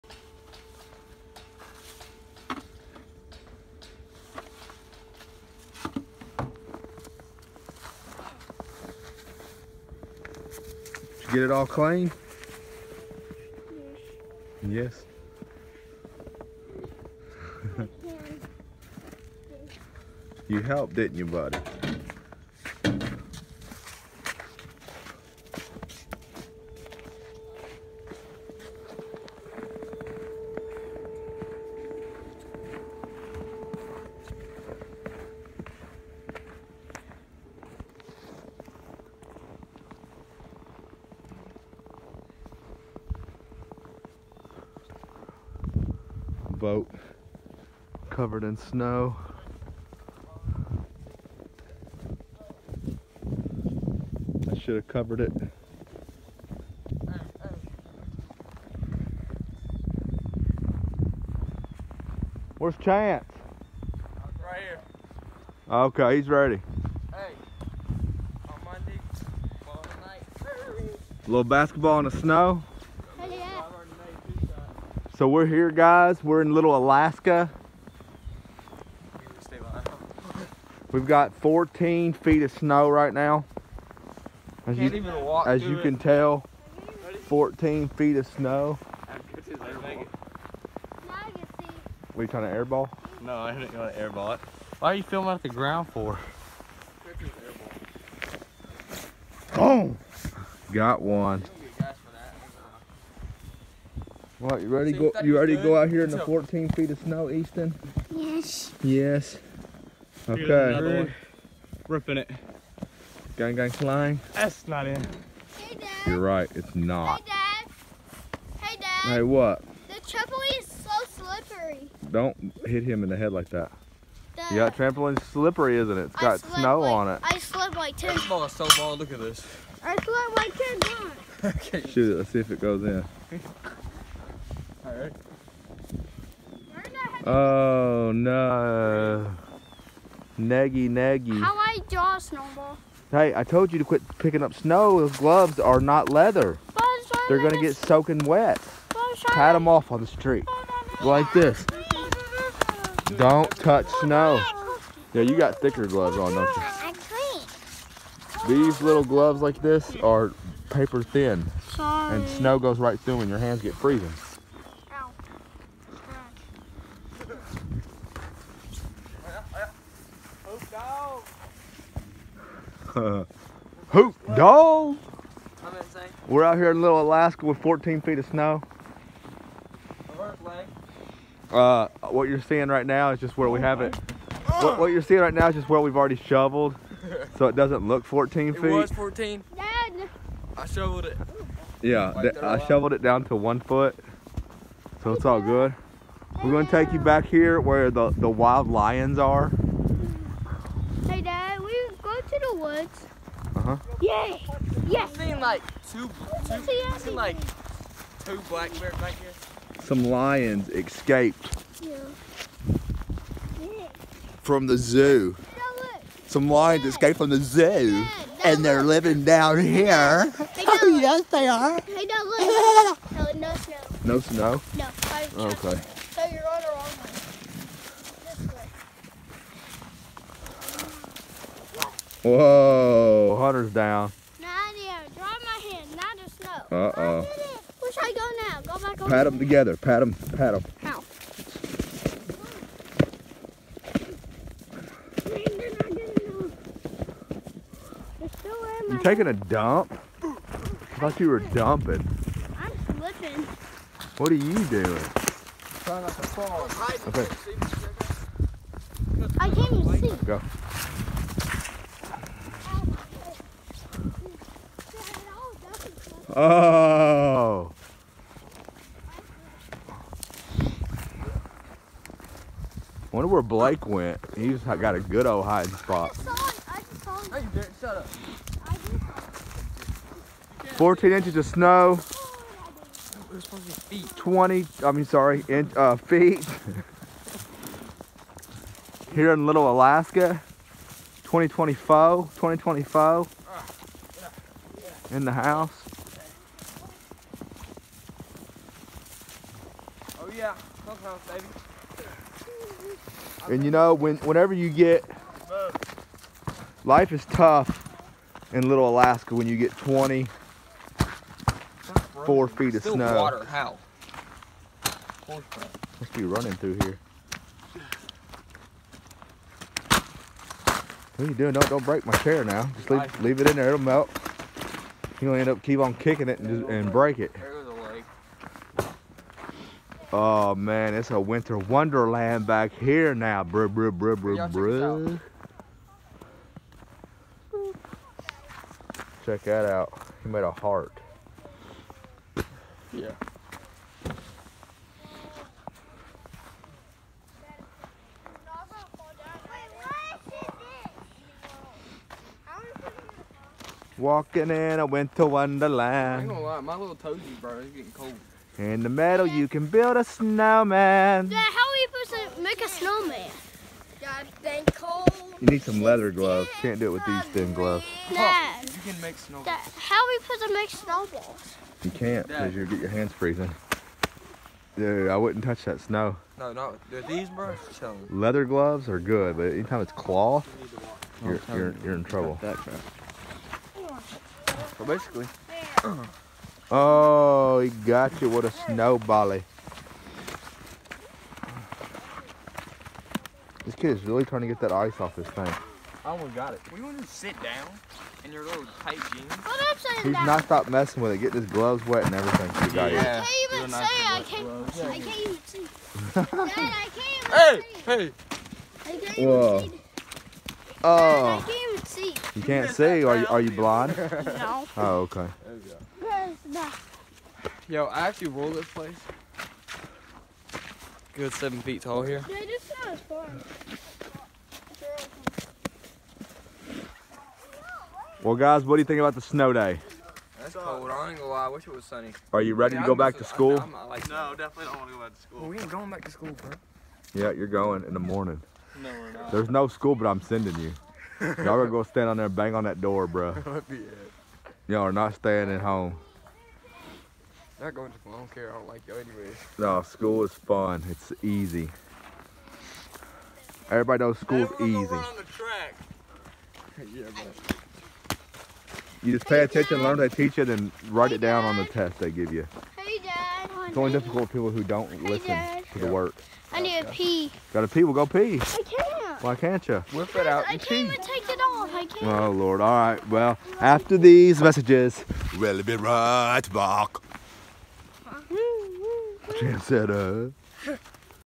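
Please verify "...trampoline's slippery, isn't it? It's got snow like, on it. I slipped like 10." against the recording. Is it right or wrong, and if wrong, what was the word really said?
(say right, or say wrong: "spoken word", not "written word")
right.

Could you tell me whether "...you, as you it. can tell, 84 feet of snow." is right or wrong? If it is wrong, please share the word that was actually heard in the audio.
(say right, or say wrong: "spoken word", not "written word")
wrong: "14", not "84".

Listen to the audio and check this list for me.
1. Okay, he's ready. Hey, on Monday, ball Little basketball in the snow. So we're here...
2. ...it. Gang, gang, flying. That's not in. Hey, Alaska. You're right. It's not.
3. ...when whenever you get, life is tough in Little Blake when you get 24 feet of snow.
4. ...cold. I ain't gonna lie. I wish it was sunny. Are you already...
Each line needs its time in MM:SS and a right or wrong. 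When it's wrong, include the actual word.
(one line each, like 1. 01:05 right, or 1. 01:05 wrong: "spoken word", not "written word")
1. 01:05 right
2. 01:52 wrong: "Dad", not "Alaska"
3. 05:03 wrong: "Alaska", not "Blake"
4. 07:10 wrong: "ready", not "already".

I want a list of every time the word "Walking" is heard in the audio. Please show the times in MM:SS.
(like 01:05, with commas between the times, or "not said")
05:53.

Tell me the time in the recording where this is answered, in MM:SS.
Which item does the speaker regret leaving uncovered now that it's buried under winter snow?
00:46.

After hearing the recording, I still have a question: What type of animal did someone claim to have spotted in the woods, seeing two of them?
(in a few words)
black bears.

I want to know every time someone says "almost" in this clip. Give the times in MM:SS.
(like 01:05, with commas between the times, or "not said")
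06:36.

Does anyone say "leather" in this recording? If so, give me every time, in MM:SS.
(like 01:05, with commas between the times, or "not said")
02:26, 06:05, 06:18.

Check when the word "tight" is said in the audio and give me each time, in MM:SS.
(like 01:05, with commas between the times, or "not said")
06:38.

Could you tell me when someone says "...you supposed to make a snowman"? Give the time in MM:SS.
06:01.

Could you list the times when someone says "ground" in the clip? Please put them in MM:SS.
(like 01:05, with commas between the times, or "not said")
01:35.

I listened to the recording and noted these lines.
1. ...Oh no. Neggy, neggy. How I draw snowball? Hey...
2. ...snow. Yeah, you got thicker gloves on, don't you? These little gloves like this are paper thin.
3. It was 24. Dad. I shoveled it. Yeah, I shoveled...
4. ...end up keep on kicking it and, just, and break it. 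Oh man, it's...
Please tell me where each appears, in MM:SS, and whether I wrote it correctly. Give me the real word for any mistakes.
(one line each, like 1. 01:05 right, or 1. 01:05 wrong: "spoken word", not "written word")
1. 02:17 right
2. 02:34 right
3. 03:08 wrong: "14", not "24"
4. 05:25 right.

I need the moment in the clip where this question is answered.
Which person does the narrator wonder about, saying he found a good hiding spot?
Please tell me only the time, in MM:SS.
04:33.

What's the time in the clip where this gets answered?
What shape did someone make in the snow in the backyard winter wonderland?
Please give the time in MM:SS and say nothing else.
05:40.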